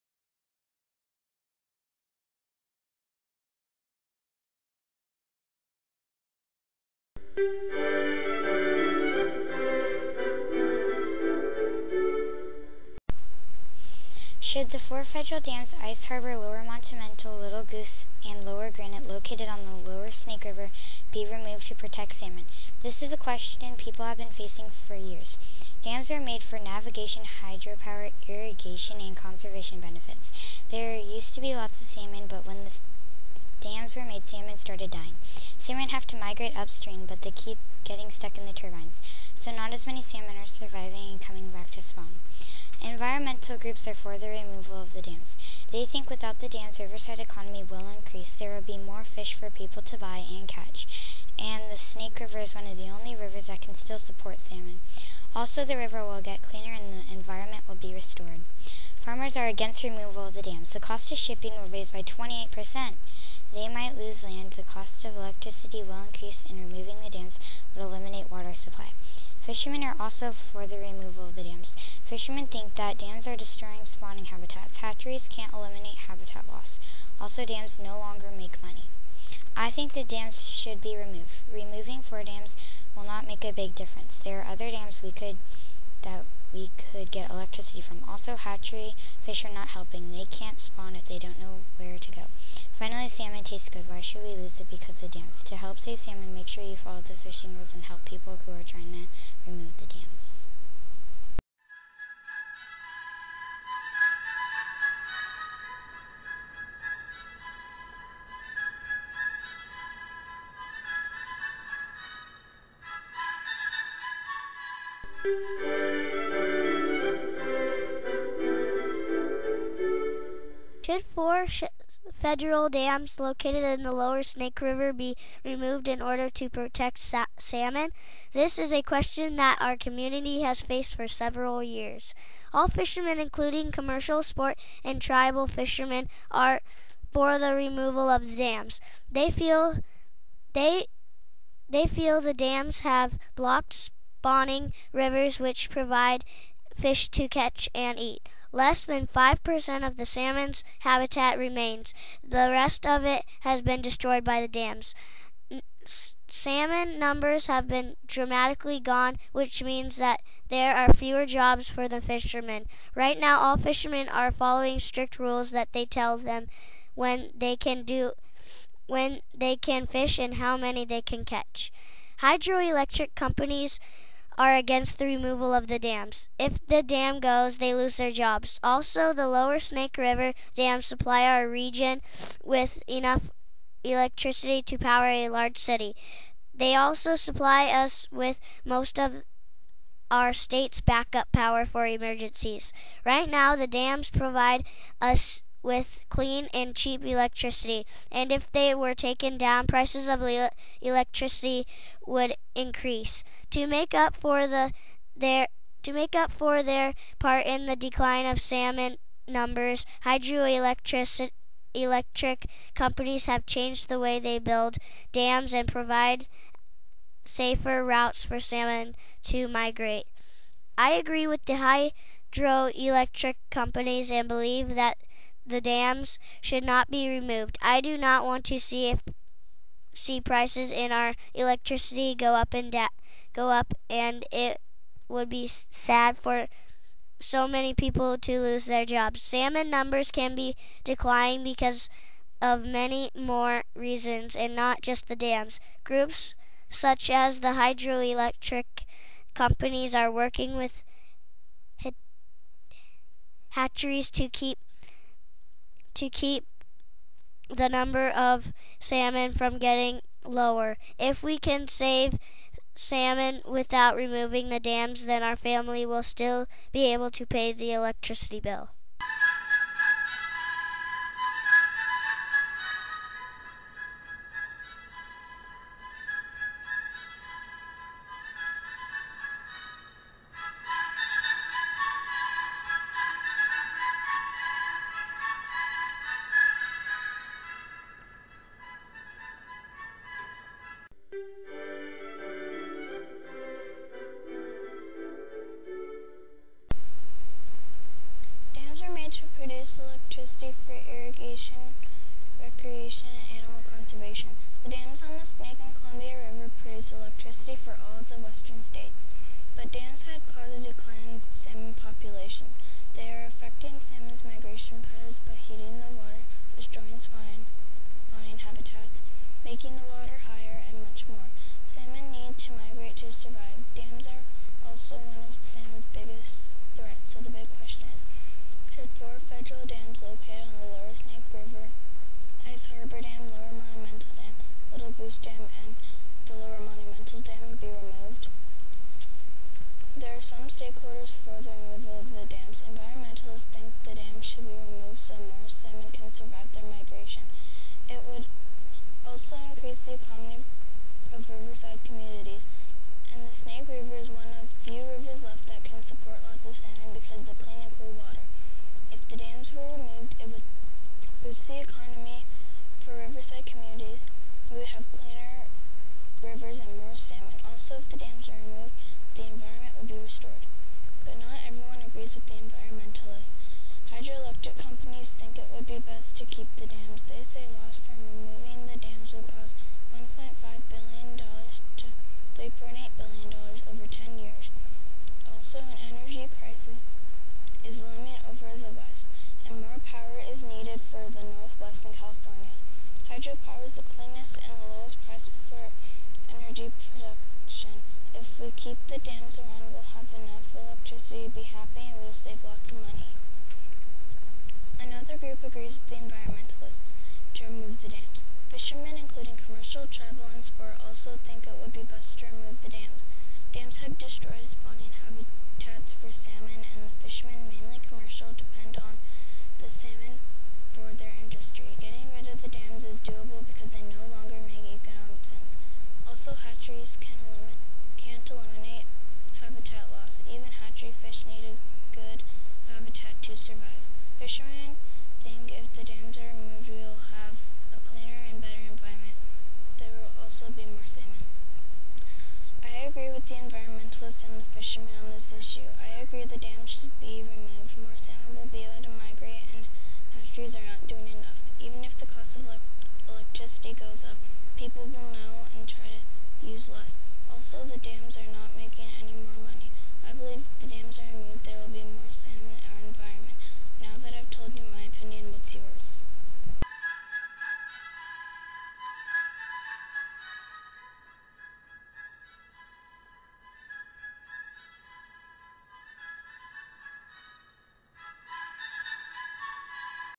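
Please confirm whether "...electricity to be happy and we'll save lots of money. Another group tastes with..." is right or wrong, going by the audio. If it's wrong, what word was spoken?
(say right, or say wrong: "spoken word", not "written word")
wrong: "agrees", not "tastes".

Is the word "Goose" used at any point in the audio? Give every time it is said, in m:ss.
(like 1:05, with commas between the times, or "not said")
0:17, 5:34.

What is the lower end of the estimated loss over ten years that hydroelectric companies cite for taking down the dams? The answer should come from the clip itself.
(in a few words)
$1.5 billion.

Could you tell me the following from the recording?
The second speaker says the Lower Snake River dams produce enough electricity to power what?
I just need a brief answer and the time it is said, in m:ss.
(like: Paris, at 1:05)
A large city, at 3:05.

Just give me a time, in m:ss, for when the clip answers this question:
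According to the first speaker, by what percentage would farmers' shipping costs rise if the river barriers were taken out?
1:02.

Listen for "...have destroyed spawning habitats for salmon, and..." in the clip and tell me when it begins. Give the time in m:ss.
6:53.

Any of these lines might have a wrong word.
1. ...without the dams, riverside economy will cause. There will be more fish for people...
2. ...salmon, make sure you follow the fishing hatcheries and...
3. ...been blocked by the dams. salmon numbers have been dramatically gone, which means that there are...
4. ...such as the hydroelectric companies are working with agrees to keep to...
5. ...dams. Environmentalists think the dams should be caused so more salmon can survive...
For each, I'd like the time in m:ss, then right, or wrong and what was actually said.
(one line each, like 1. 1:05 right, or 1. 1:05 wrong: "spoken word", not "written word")
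1. 0:46 wrong: "increase", not "cause"
2. 1:35 wrong: "rules", not "hatcheries"
3. 2:33 wrong: "destroyed", not "blocked"
4. 4:06 wrong: "hatcheries", not "agrees"
5. 5:42 wrong: "removed", not "caused".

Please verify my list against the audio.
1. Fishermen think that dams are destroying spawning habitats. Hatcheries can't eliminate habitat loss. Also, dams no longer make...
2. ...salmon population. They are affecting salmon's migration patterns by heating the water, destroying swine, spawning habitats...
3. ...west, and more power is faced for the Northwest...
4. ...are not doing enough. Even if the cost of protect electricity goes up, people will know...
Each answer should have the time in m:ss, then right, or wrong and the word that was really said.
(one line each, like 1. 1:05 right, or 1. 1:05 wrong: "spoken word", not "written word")
1. 1:12 right
2. 5:11 right
3. 6:28 wrong: "needed", not "faced"
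4. 7:30 wrong: "elect", not "protect".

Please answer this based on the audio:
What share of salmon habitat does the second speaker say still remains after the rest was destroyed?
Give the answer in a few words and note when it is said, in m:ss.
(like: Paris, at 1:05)
Less than 5%, at 2:28.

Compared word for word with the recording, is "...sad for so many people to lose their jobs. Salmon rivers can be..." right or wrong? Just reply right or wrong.
wrong.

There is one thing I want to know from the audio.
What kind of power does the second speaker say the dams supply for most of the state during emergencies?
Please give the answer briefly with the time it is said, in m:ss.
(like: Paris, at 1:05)
Backup power, at 3:10.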